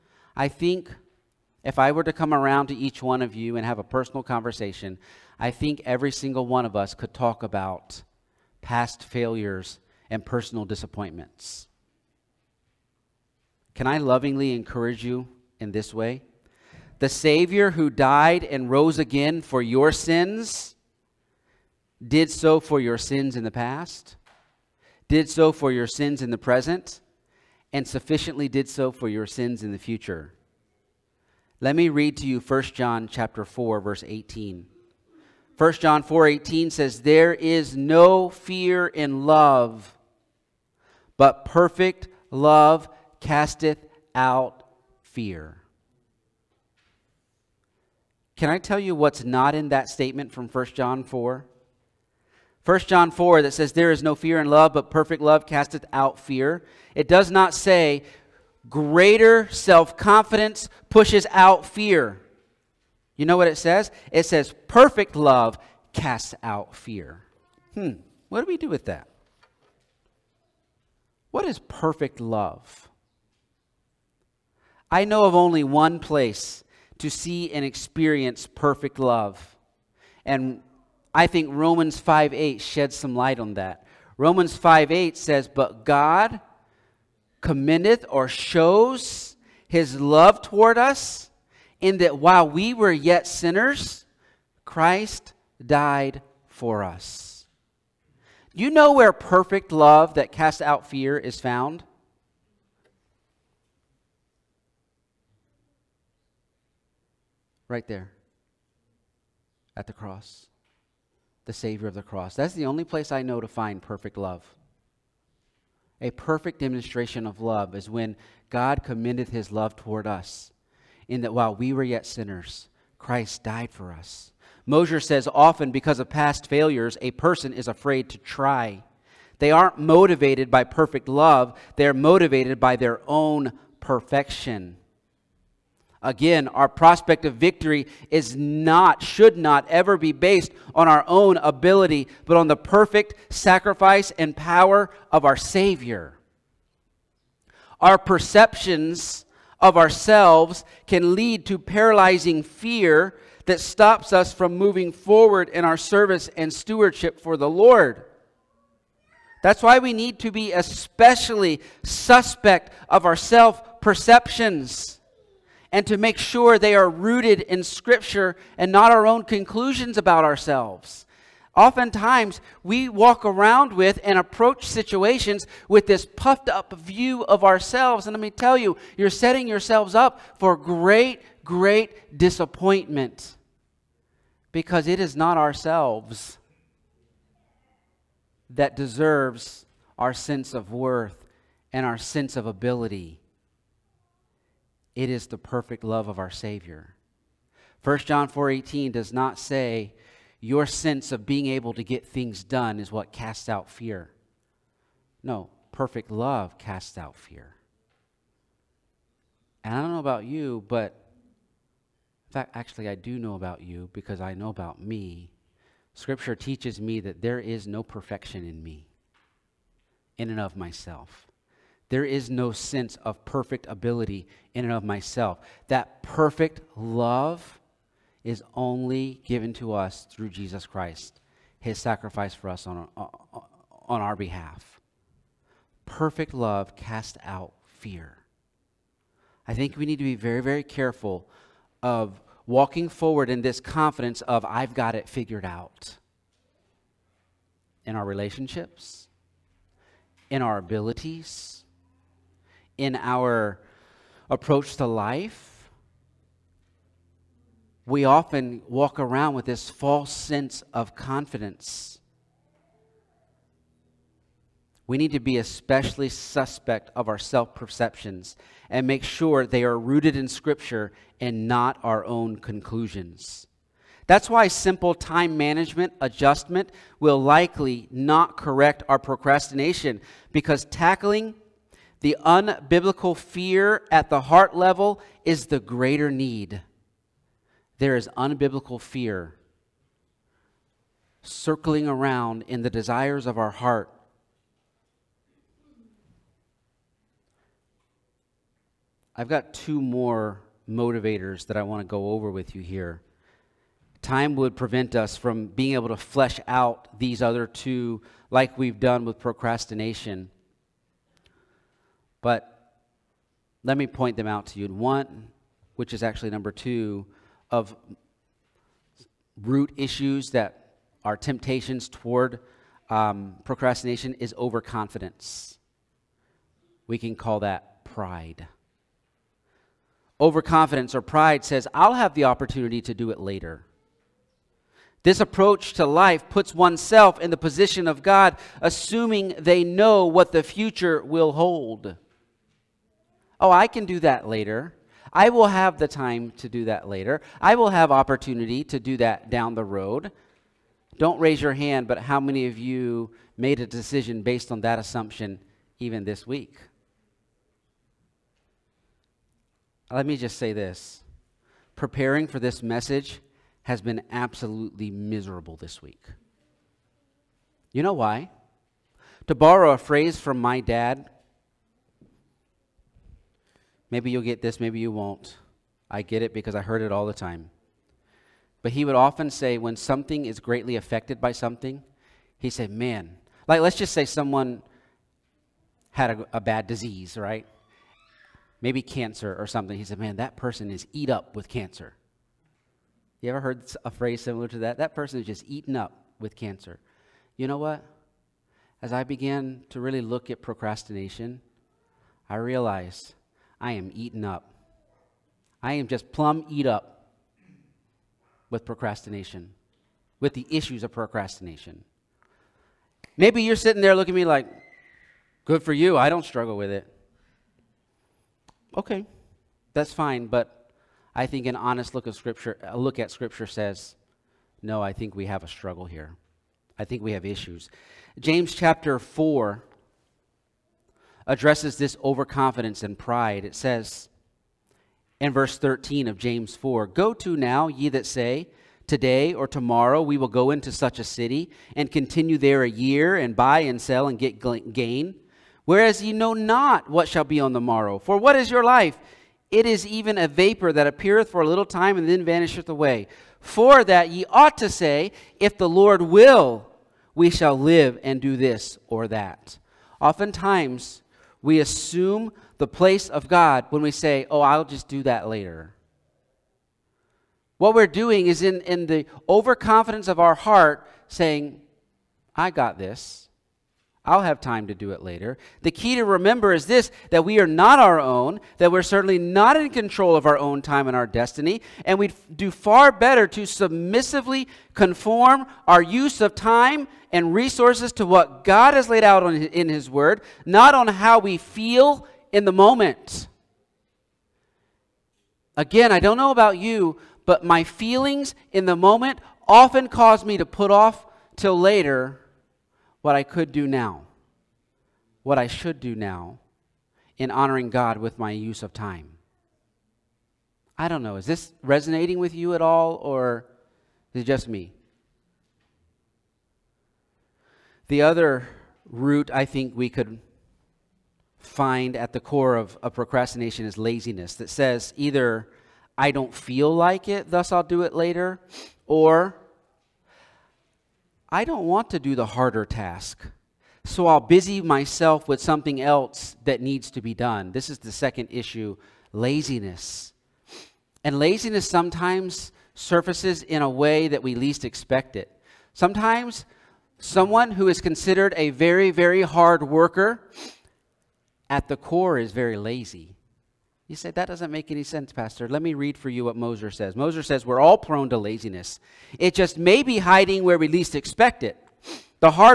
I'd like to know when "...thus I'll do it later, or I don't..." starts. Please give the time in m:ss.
8:47.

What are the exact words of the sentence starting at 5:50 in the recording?
Don't raise your hand, but how many of you made a decision based on that assumption even this week?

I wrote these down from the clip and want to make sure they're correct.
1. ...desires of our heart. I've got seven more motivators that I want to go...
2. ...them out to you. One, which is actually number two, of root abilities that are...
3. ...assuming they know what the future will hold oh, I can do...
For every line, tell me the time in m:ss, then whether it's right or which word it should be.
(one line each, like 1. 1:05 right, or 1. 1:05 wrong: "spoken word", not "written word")
1. 4:52 wrong: "two", not "seven"
2. 5:14 wrong: "issues", not "abilities"
3. 5:38 right.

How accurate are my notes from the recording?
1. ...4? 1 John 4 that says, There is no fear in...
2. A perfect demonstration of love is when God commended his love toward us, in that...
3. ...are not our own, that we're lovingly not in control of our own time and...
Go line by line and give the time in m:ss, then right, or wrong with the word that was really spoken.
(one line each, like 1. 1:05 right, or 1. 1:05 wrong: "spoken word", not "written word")
1. 0:51 right
2. 1:56 right
3. 7:57 wrong: "certainly", not "lovingly".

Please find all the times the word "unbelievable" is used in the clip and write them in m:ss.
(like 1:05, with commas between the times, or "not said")
not said.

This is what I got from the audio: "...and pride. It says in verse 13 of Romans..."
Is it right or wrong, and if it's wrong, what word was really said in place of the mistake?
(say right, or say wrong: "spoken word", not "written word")
wrong: "James", not "Romans".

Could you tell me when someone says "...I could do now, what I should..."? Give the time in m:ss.
8:23.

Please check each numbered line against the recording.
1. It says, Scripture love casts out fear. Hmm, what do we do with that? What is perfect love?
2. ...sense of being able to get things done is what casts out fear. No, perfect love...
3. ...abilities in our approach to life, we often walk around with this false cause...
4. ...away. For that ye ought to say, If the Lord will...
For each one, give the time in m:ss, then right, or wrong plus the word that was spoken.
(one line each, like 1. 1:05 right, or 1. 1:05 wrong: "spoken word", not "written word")
1. 1:04 wrong: "Perfect", not "Scripture"
2. 3:20 right
3. 4:10 wrong: "sense", not "cause"
4. 7:32 right.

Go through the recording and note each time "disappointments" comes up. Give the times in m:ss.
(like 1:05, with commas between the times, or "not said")
0:10, 3:02.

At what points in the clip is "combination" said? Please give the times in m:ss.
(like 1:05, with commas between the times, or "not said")
not said.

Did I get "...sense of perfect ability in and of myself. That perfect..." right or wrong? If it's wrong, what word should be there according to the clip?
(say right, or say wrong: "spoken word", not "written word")
right.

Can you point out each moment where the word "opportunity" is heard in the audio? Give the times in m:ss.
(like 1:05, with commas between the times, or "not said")
5:32, 5:47.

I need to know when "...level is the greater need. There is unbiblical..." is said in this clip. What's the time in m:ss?
4:44.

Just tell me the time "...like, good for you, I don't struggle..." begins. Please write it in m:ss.
6:54.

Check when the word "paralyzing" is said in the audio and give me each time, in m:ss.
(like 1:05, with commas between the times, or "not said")
2:31.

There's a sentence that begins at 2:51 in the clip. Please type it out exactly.
Oftentimes, we walk around with and approach situations with this puffed up view of ourselves.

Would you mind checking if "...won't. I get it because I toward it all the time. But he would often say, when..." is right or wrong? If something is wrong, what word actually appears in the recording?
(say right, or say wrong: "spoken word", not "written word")
wrong: "heard", not "toward".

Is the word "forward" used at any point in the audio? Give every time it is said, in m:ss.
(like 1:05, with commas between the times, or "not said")
2:34, 4:02.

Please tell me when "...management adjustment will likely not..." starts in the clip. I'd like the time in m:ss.
4:35.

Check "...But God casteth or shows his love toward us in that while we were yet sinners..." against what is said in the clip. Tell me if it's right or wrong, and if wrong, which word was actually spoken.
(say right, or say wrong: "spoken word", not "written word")
wrong: "commendeth", not "casteth".